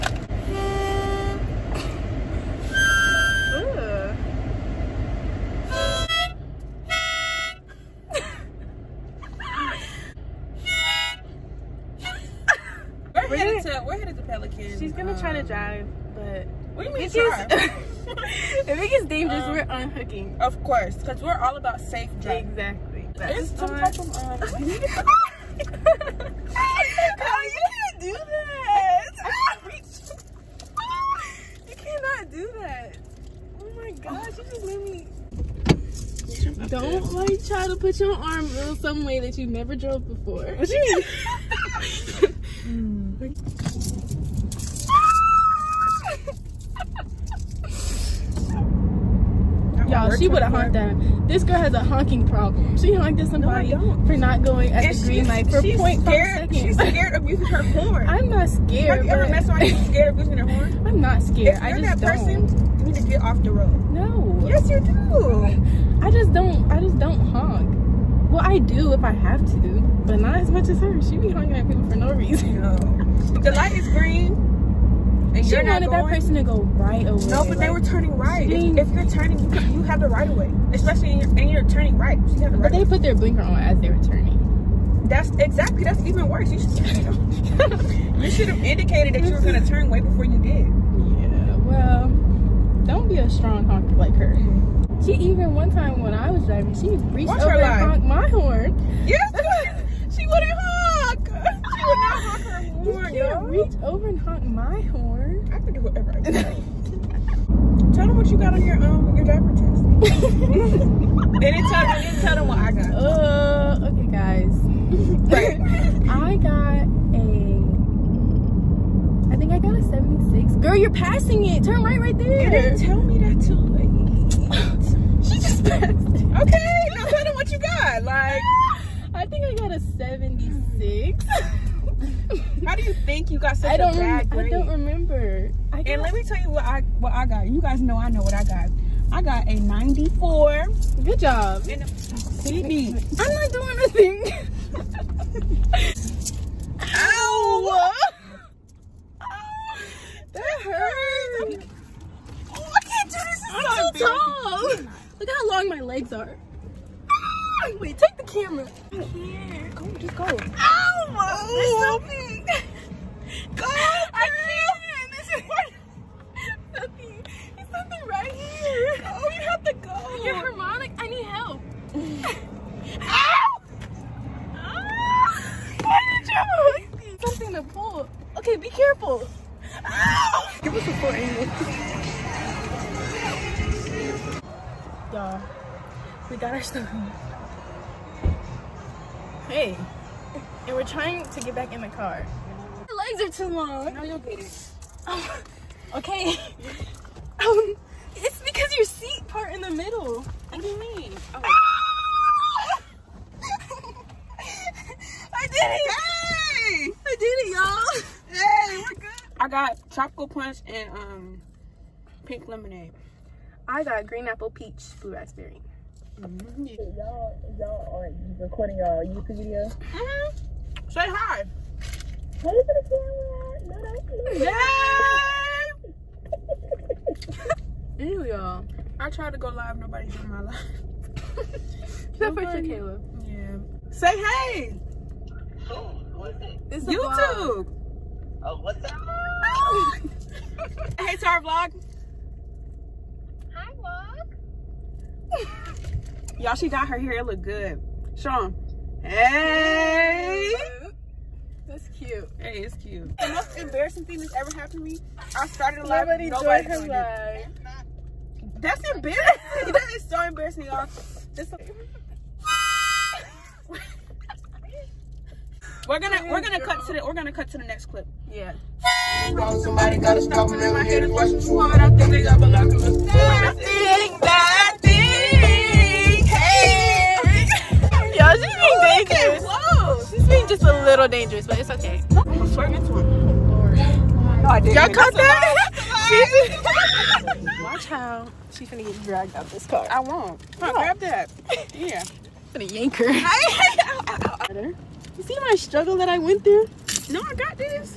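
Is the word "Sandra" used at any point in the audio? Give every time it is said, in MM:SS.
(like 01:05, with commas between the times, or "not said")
not said.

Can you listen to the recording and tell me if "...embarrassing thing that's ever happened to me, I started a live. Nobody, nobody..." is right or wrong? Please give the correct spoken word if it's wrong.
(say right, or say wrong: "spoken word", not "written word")
right.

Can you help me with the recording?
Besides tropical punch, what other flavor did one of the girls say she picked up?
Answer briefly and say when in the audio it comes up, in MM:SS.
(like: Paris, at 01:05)
Pink lemonade, at 03:32.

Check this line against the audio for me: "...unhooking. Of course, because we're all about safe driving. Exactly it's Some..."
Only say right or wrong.
right.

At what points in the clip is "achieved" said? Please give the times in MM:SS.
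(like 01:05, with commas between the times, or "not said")
not said.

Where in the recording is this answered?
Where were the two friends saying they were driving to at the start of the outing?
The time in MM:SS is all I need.
00:14.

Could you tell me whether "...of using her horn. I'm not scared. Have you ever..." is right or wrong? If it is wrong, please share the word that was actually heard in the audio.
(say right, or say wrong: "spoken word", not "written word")
right.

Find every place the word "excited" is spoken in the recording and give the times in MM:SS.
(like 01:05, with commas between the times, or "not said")
not said.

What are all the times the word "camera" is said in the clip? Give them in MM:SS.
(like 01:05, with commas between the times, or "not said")
02:38, 03:43.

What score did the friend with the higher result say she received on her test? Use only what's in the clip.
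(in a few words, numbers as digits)
94.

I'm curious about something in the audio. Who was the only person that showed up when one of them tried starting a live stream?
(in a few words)
Caleb.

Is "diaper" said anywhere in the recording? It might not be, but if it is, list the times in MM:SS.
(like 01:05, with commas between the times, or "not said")
01:49.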